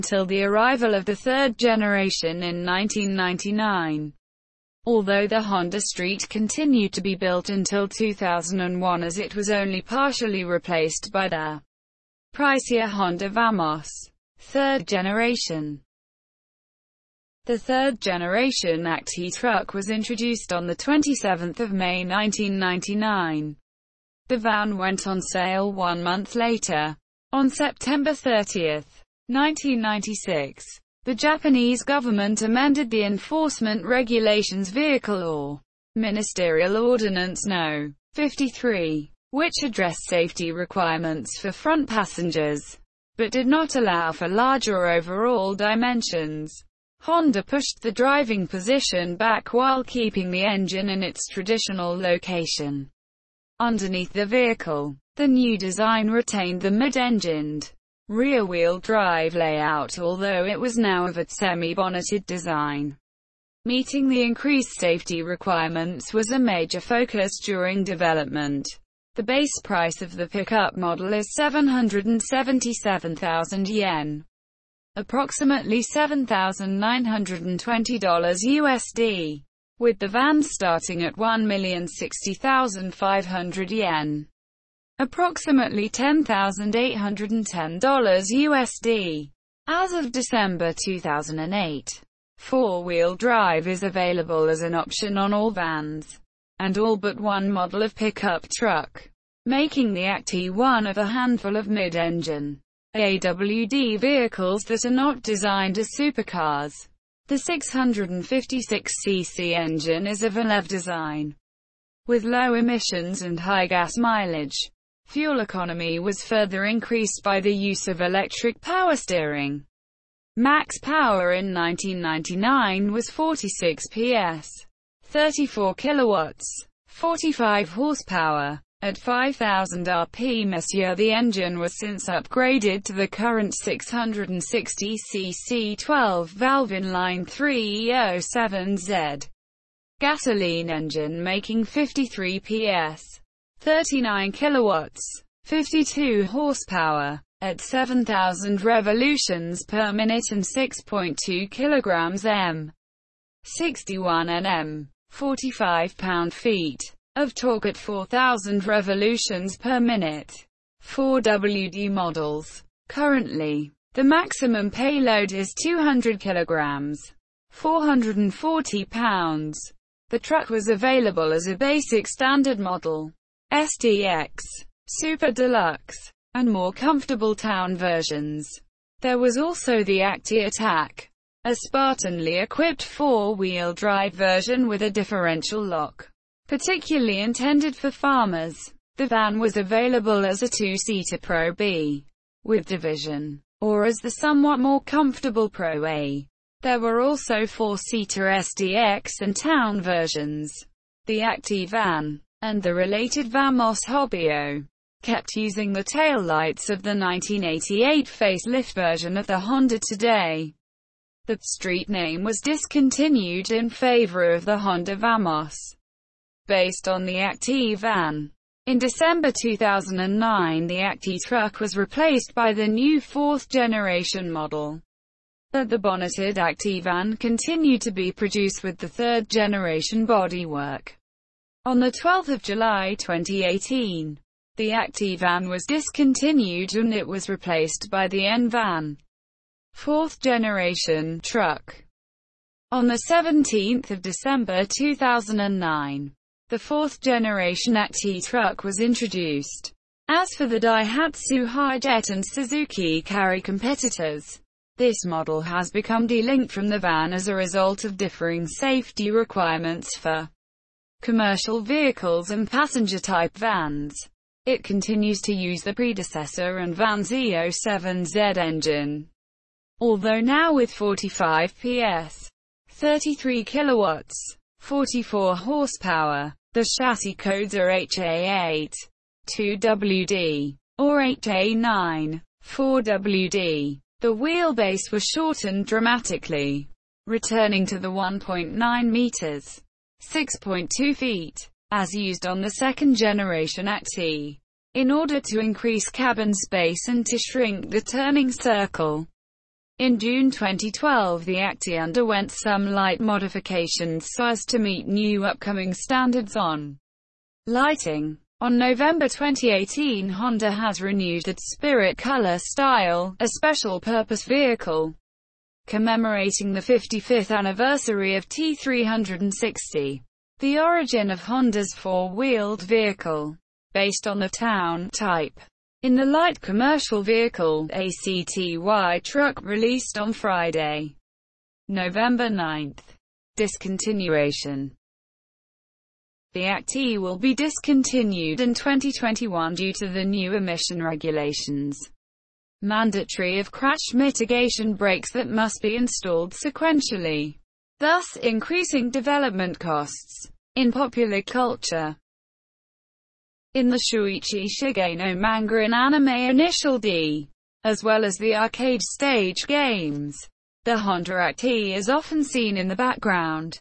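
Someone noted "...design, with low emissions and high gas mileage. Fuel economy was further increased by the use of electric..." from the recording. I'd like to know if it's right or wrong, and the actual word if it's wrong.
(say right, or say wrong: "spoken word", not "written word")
right.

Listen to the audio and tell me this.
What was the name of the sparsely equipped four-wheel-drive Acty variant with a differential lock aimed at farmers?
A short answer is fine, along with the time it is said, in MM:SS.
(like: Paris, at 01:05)
Acty Attack, at 02:59.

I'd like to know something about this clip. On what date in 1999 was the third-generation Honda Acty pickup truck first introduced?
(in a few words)
27th of May.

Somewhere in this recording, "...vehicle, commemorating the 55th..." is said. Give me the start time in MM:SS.
05:14.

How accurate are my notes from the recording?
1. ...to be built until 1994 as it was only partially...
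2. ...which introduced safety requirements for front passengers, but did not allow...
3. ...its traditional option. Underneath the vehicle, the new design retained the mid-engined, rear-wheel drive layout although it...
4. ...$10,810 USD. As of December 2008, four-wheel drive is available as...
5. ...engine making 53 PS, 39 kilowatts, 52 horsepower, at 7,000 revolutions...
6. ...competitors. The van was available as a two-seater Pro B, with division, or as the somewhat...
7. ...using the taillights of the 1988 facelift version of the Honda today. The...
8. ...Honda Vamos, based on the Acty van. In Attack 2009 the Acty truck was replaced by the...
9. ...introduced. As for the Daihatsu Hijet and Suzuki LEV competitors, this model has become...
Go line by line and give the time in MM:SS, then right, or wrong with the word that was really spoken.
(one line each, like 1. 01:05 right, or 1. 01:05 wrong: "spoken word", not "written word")
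1. 00:06 wrong: "2001", not "1994"
2. 00:39 wrong: "addressed", not "introduced"
3. 00:51 wrong: "location", not "option"
4. 01:25 right
5. 02:20 right
6. 03:07 wrong: "farmers", not "competitors"
7. 03:25 right
8. 03:34 wrong: "December", not "Attack"
9. 04:08 wrong: "Carry", not "LEV".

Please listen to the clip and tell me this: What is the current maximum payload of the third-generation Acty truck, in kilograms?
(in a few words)
200 kilograms.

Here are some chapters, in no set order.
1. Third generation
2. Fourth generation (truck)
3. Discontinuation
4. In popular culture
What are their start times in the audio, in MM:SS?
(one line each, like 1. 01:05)
1. 00:14
2. 03:59
3. 05:33
4. 05:50.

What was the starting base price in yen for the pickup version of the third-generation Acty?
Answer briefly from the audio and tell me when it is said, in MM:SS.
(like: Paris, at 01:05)
777,000 yen, at 01:11.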